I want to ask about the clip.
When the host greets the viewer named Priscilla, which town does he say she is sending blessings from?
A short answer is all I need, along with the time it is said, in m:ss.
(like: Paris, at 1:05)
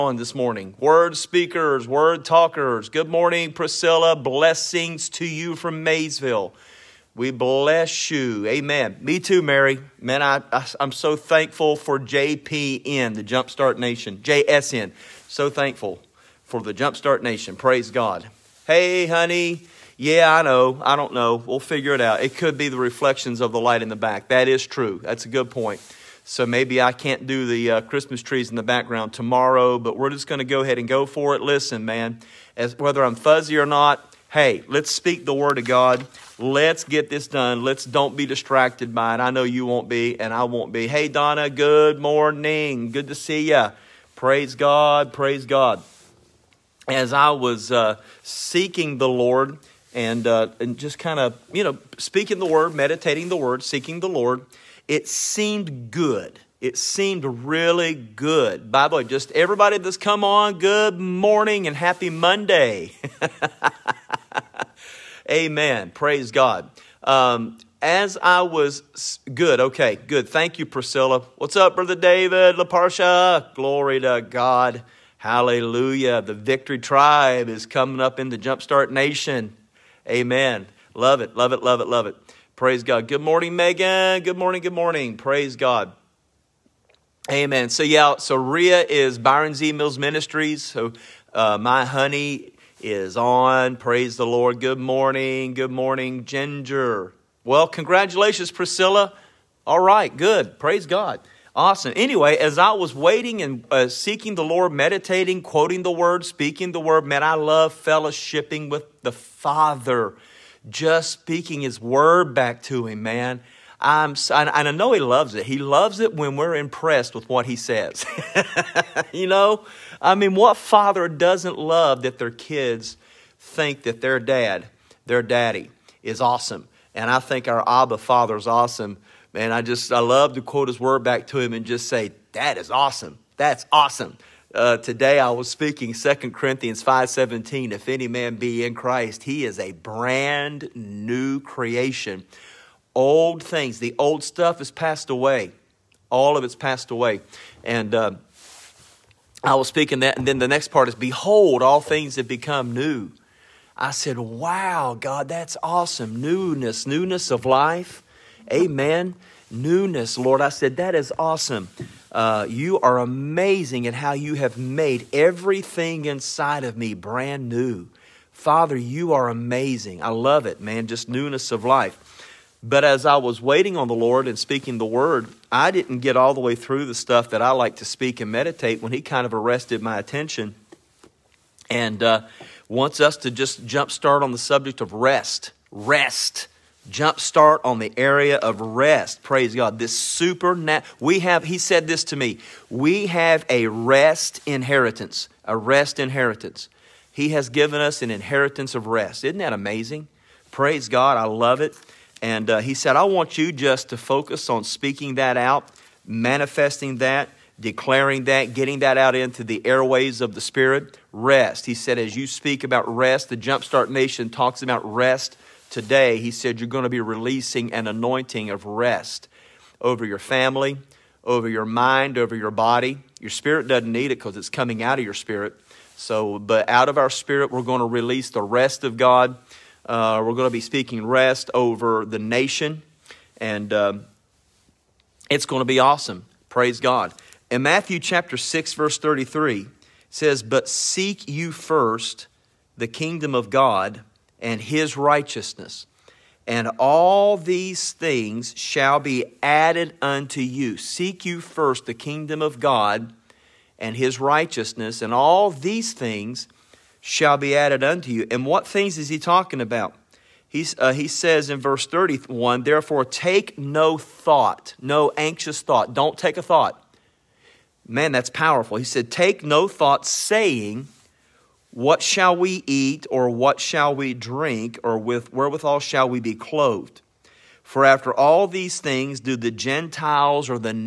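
Maysville, at 0:05.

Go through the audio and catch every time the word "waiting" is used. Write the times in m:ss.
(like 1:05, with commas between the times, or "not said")
1:42, 2:53.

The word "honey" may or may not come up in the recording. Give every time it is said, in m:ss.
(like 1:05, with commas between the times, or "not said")
0:19, 1:31.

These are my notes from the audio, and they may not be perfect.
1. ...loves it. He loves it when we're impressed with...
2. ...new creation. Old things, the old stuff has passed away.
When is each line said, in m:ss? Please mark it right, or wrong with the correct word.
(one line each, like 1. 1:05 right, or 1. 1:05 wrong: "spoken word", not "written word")
1. 1:54 right
2. 2:20 right.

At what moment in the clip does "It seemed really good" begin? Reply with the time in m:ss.
0:56.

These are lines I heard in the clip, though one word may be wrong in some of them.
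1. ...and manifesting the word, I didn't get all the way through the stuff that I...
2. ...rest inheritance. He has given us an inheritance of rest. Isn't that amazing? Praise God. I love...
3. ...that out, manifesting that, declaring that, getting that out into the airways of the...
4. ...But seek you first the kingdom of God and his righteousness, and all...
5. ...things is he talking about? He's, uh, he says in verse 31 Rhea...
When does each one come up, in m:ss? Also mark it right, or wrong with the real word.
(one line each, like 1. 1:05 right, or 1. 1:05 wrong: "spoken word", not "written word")
1. 2:54 wrong: "speaking", not "manifesting"
2. 3:15 right
3. 3:25 right
4. 4:00 right
5. 4:18 wrong: "Therefore", not "Rhea".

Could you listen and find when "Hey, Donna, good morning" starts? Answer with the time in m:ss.
0:40.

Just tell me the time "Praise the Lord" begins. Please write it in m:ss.
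1:33.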